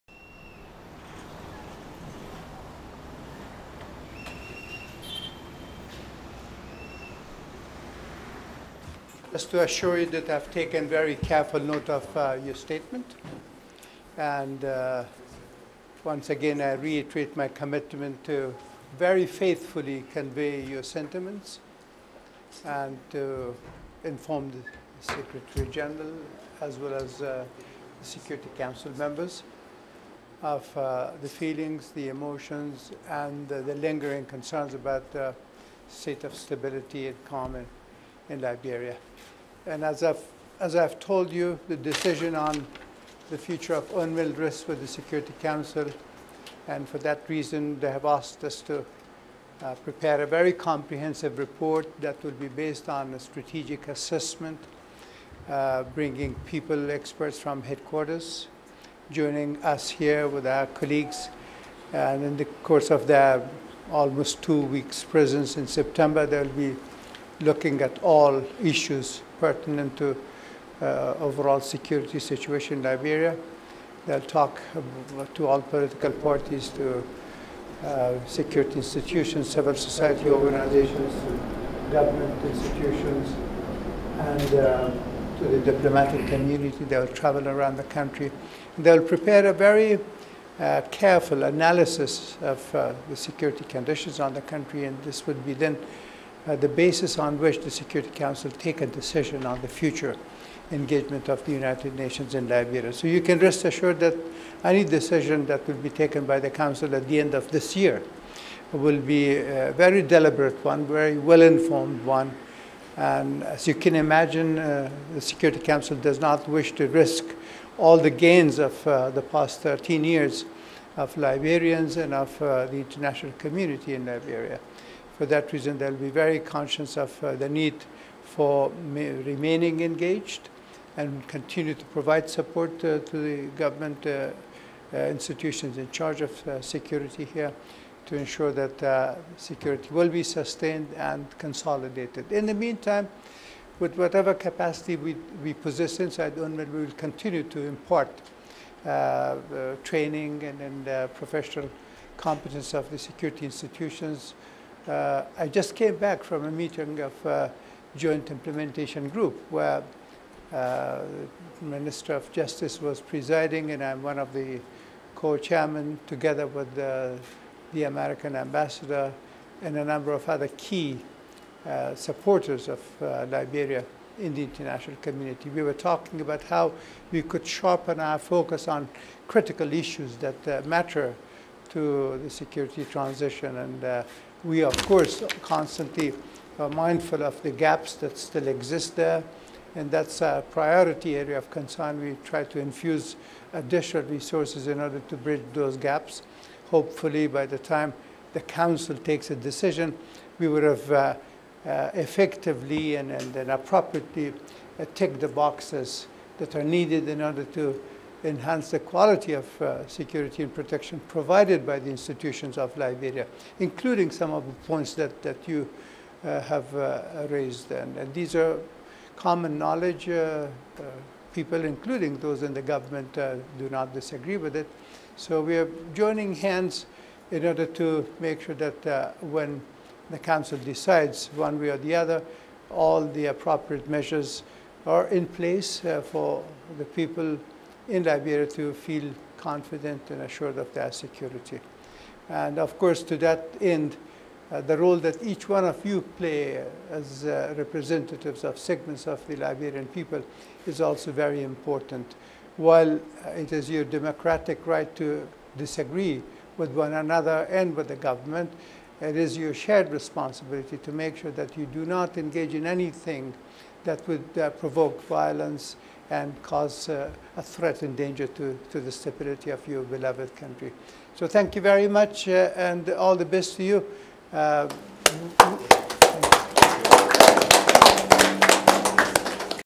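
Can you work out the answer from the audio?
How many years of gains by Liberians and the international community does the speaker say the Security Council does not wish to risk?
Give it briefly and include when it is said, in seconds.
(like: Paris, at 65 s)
13, at 119 s.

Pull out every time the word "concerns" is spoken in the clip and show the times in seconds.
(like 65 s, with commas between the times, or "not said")
34 s, 191 s.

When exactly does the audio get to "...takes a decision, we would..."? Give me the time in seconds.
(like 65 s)
198 s.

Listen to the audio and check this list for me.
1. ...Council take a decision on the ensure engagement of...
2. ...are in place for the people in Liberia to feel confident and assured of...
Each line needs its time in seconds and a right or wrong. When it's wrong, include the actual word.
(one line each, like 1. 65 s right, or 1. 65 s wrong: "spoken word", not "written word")
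1. 98 s wrong: "future", not "ensure"
2. 234 s right.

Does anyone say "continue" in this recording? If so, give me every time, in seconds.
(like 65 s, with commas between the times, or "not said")
131 s, 146 s.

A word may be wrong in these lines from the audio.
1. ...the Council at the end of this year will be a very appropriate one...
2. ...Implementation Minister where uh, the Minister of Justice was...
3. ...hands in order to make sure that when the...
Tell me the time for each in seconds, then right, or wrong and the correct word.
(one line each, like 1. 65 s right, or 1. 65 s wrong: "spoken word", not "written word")
1. 106 s wrong: "deliberate", not "appropriate"
2. 158 s wrong: "Group", not "Minister"
3. 226 s right.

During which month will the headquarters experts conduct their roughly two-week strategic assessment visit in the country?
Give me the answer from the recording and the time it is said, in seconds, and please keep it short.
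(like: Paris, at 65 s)
September, at 65 s.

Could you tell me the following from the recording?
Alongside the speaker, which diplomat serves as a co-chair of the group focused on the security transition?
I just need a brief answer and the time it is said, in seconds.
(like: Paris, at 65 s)
American ambassador, at 167 s.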